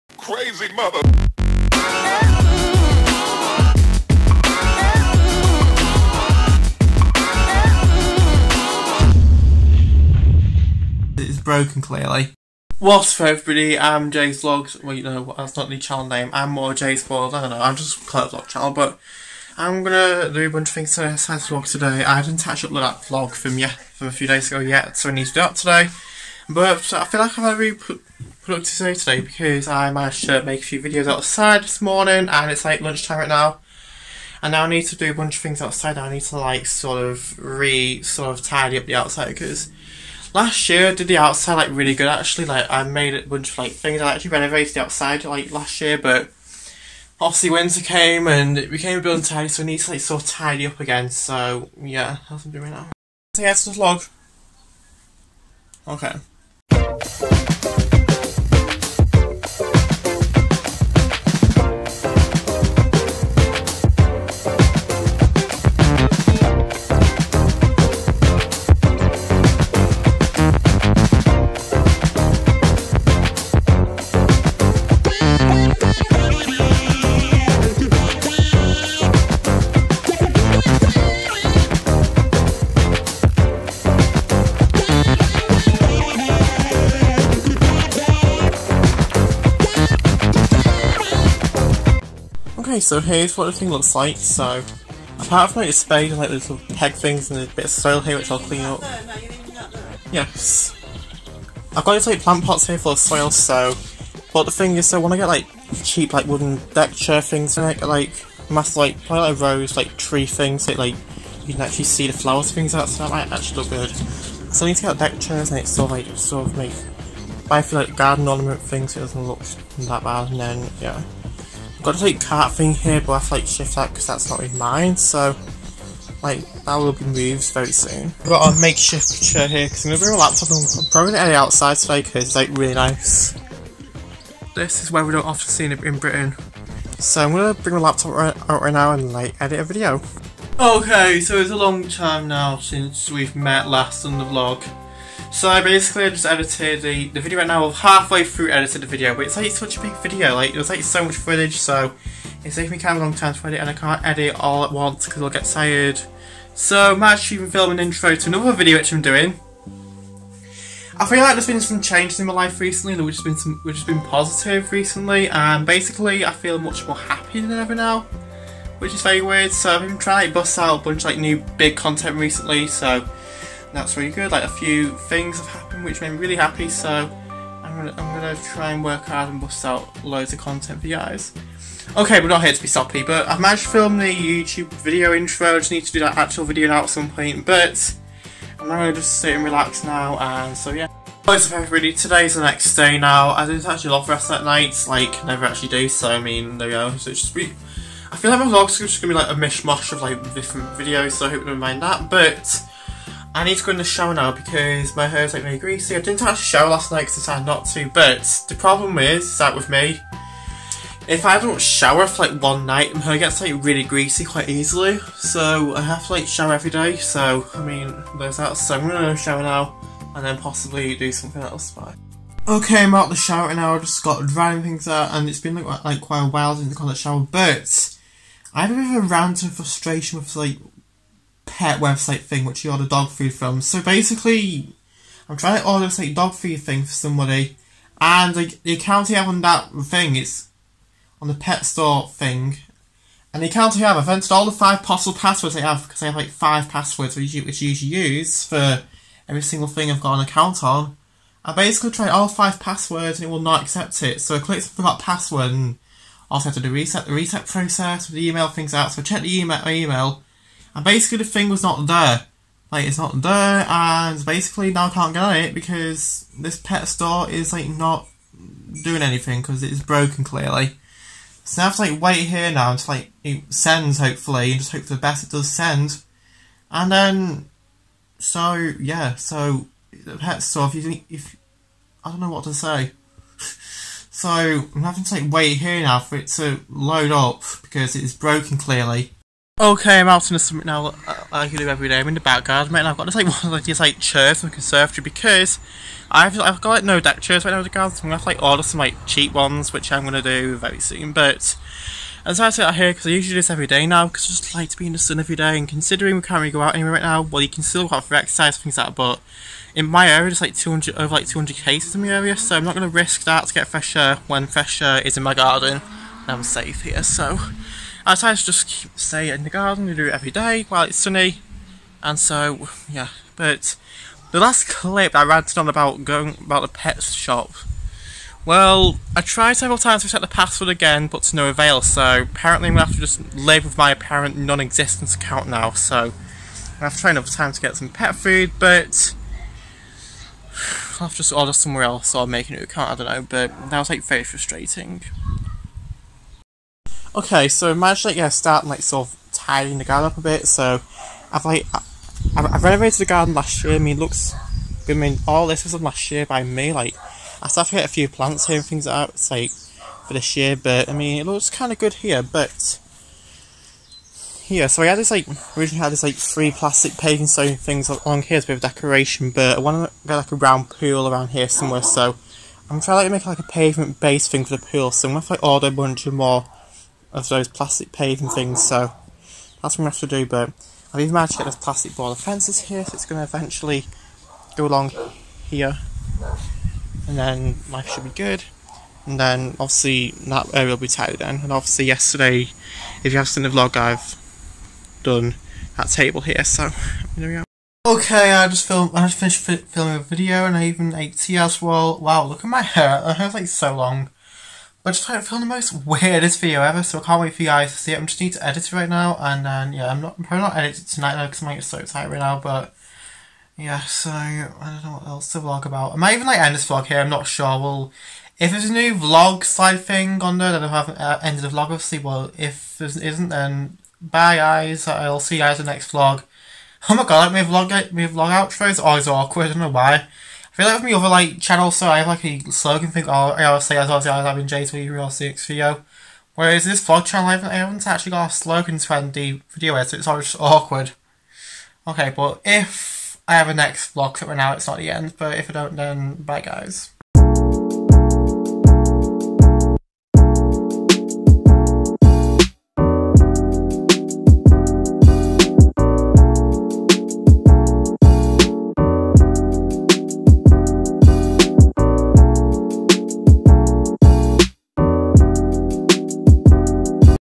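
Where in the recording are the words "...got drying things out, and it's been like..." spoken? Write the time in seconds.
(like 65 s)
224 s.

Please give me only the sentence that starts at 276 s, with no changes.
And then, so, yeah, so, the pet store, if you think, if, I don't know what to say.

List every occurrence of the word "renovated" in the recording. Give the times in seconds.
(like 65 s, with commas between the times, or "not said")
44 s, 352 s.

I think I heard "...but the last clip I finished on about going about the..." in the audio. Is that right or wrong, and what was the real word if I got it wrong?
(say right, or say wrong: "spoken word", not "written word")
wrong: "ranted", not "finished".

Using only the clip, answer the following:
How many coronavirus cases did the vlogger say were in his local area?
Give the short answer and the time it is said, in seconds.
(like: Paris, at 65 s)
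200, at 310 s.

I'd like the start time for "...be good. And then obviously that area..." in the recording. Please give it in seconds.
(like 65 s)
388 s.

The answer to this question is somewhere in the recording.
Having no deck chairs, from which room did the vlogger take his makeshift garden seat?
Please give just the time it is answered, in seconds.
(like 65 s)
294 s.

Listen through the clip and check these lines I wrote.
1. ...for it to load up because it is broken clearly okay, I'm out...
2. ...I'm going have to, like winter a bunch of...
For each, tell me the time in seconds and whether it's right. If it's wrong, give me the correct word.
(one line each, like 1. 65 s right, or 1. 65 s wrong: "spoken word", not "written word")
1. 285 s right
2. 375 s wrong: "order", not "winter".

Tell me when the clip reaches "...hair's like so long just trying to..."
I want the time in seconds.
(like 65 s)
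403 s.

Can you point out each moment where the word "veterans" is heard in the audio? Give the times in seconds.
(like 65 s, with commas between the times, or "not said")
not said.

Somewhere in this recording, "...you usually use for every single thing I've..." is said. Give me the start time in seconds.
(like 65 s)
247 s.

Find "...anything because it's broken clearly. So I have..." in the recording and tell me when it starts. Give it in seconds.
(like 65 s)
269 s.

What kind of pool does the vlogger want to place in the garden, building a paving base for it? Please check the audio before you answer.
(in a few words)
A round pool.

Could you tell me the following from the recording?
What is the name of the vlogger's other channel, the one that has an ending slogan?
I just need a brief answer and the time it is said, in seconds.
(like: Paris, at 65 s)
J306, at 434 s.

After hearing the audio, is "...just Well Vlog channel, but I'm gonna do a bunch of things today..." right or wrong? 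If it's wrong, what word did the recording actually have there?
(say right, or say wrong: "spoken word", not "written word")
wrong: "Claire", not "Well".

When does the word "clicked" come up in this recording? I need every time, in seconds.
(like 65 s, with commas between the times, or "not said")
254 s.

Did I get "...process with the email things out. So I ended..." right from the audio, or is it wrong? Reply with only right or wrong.
wrong.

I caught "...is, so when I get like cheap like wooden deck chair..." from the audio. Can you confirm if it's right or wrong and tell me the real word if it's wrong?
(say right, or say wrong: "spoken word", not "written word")
right.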